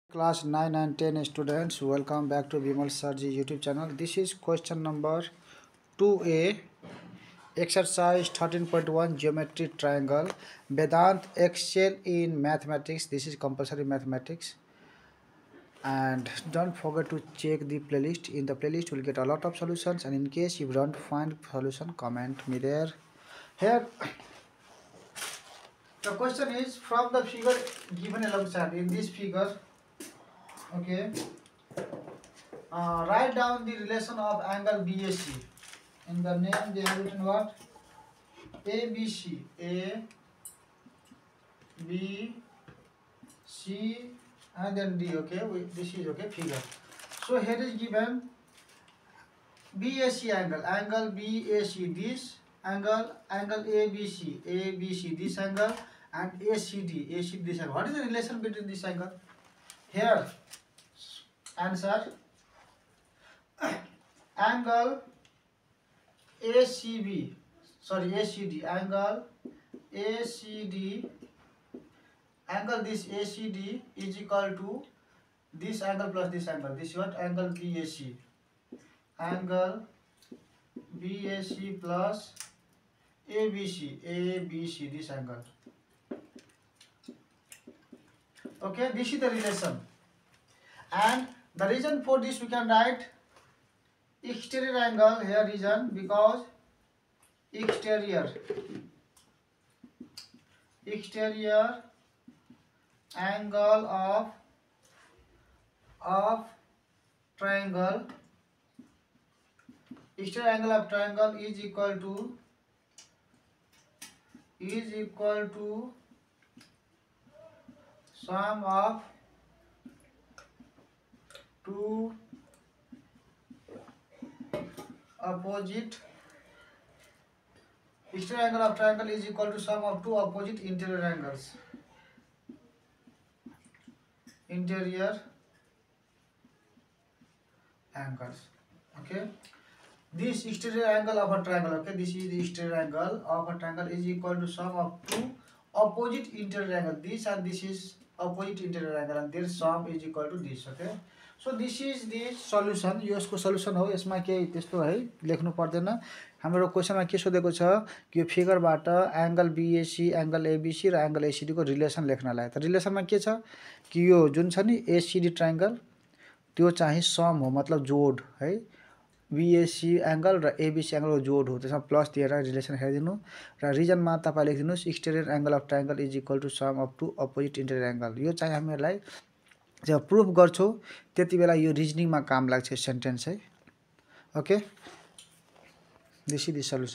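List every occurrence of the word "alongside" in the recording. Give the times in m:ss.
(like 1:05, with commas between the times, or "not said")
0:28.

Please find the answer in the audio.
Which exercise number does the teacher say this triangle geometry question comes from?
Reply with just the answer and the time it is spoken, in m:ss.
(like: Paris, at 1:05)
13.1, at 0:07.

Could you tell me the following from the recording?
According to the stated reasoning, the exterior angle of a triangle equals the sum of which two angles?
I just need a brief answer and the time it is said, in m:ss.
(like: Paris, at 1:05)
Two opposite interior angles, at 2:10.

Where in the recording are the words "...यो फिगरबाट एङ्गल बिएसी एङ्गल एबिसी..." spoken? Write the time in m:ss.
2:38.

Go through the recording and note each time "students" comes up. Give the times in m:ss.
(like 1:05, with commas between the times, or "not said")
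0:01.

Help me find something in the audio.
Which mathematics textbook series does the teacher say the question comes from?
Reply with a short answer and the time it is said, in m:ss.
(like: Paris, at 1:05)
Vedant Excel in Mathematics, at 0:10.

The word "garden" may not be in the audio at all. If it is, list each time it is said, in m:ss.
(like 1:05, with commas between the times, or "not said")
not said.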